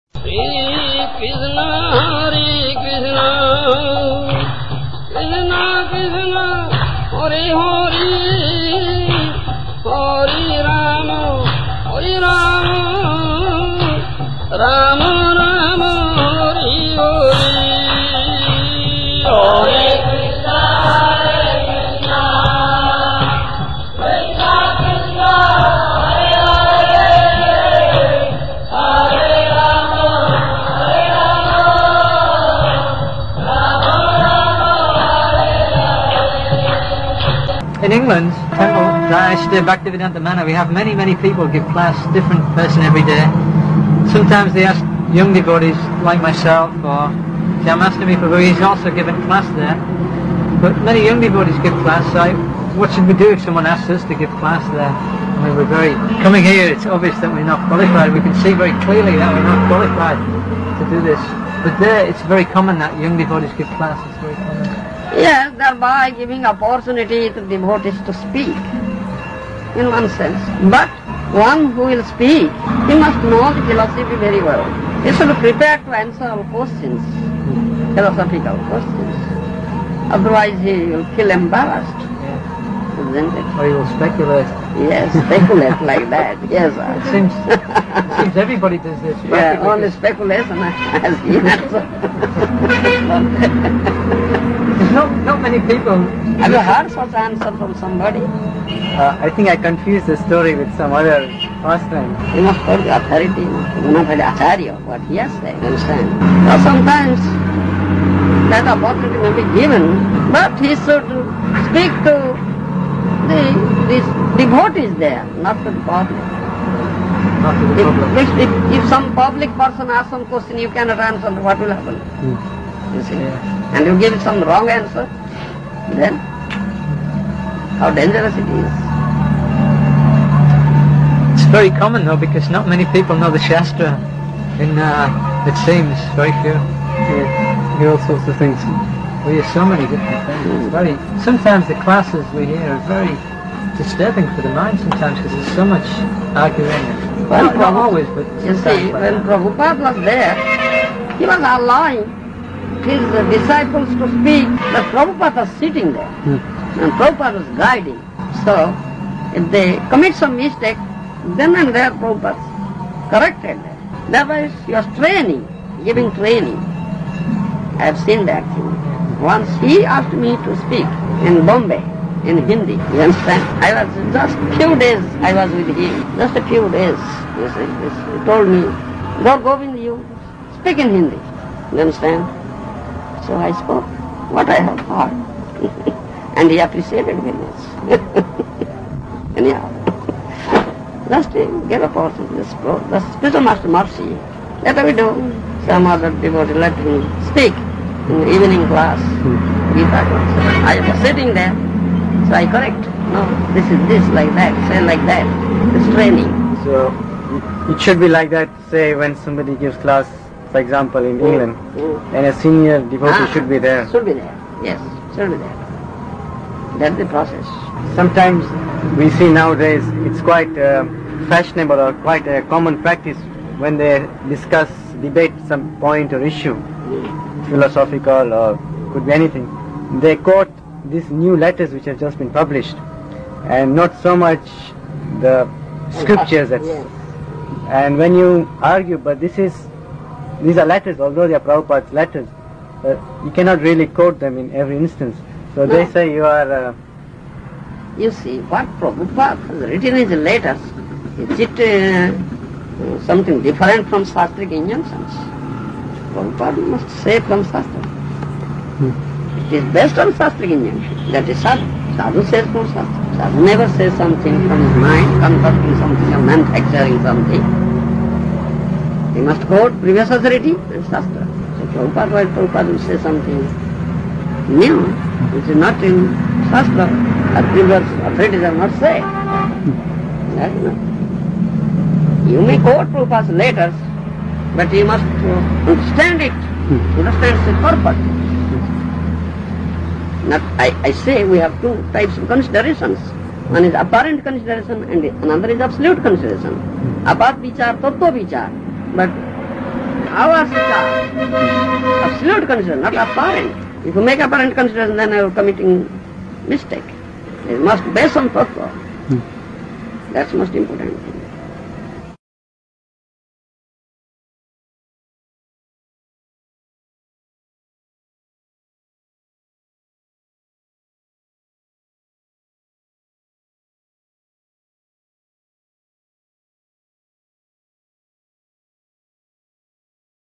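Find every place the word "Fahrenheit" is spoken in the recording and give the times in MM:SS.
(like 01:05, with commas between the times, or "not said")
not said.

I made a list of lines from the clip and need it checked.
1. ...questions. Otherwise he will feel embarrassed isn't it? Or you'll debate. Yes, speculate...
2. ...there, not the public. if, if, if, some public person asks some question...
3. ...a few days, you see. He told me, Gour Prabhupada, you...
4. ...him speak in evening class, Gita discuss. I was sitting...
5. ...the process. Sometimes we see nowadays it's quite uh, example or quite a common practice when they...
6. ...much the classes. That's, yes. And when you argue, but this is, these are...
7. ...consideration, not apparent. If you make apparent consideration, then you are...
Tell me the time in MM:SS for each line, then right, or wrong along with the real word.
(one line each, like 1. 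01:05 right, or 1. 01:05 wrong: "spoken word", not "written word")
1. 01:18 wrong: "speculate", not "debate"
2. 01:54 right
3. 02:56 wrong: "Govinda", not "Prabhupada"
4. 03:16 wrong: "class", not "discuss"
5. 03:36 wrong: "fashionable", not "example"
6. 03:54 wrong: "scriptures", not "classes"
7. 05:02 right.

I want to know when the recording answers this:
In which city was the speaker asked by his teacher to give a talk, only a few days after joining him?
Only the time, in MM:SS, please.
02:51.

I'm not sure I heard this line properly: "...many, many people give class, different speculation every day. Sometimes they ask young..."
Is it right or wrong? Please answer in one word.
wrong.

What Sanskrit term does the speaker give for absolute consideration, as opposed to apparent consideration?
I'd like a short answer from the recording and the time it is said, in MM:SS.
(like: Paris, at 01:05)
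tattva vichar, at 04:57.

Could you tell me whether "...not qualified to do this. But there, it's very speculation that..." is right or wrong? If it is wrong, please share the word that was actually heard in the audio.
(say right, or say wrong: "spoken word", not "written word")
wrong: "common", not "speculation".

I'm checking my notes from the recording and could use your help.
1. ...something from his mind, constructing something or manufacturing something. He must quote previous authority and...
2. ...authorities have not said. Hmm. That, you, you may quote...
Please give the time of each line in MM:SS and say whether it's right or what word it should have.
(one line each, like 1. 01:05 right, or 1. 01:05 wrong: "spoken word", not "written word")
1. 04:23 right
2. 04:38 right.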